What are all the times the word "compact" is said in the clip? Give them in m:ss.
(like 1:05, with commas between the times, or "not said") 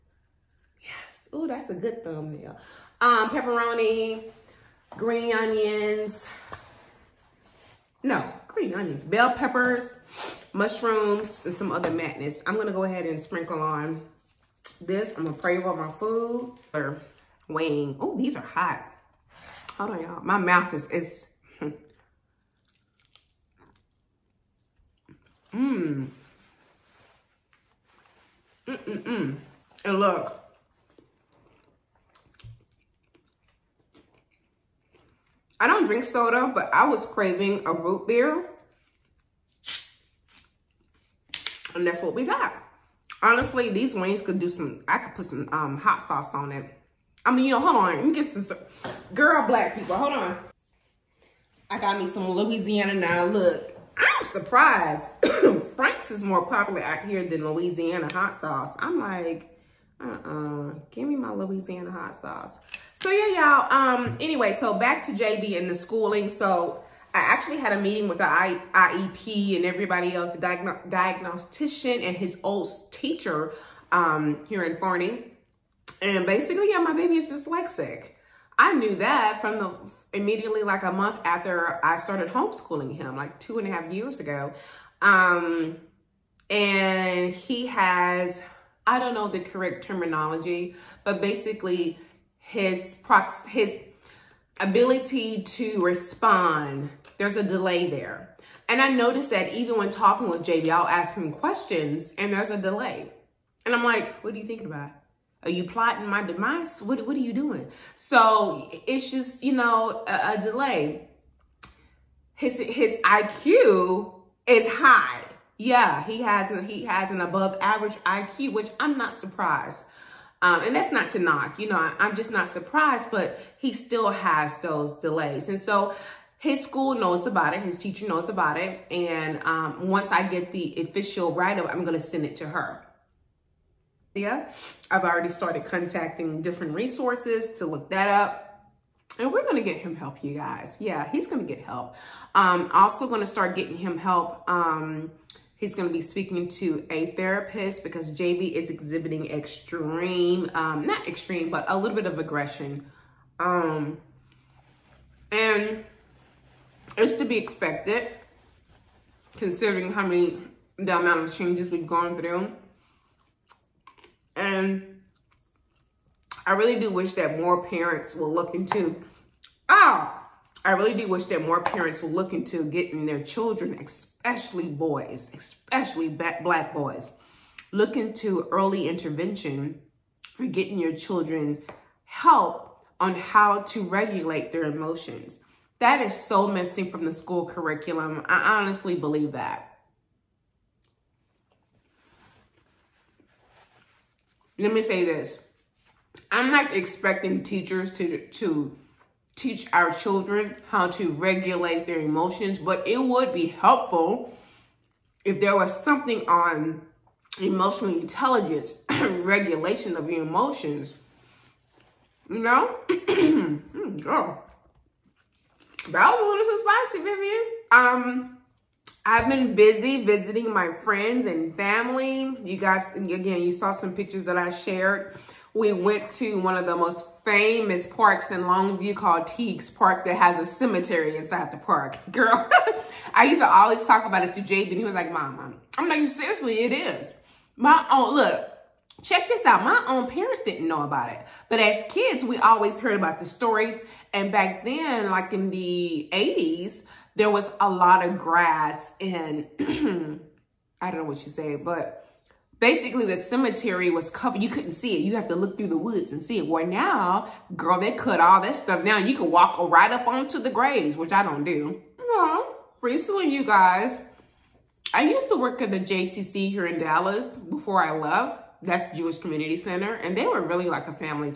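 not said.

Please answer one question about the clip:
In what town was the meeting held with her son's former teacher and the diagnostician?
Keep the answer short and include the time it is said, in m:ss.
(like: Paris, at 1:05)
Forney, at 1:14.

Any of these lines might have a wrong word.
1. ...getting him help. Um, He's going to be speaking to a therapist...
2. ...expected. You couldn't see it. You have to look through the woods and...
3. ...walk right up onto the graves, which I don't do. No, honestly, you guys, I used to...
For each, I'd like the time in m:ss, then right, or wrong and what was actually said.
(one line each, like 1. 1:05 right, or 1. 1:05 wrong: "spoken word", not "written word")
1. 2:23 right
2. 4:14 wrong: "covered", not "expected"
3. 4:19 wrong: "recently", not "honestly".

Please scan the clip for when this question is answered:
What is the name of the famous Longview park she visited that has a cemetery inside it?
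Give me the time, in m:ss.
3:49.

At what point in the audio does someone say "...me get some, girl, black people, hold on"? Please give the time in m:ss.
0:48.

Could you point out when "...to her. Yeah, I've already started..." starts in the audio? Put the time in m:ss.
2:12.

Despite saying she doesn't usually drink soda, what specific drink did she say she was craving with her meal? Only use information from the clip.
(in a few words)
Root beer.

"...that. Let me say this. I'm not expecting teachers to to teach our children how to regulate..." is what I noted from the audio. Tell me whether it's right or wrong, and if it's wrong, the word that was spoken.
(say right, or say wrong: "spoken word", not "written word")
right.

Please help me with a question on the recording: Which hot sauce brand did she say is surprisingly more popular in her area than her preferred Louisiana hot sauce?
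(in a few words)
Frank's.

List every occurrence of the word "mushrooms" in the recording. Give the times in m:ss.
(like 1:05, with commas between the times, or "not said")
0:10.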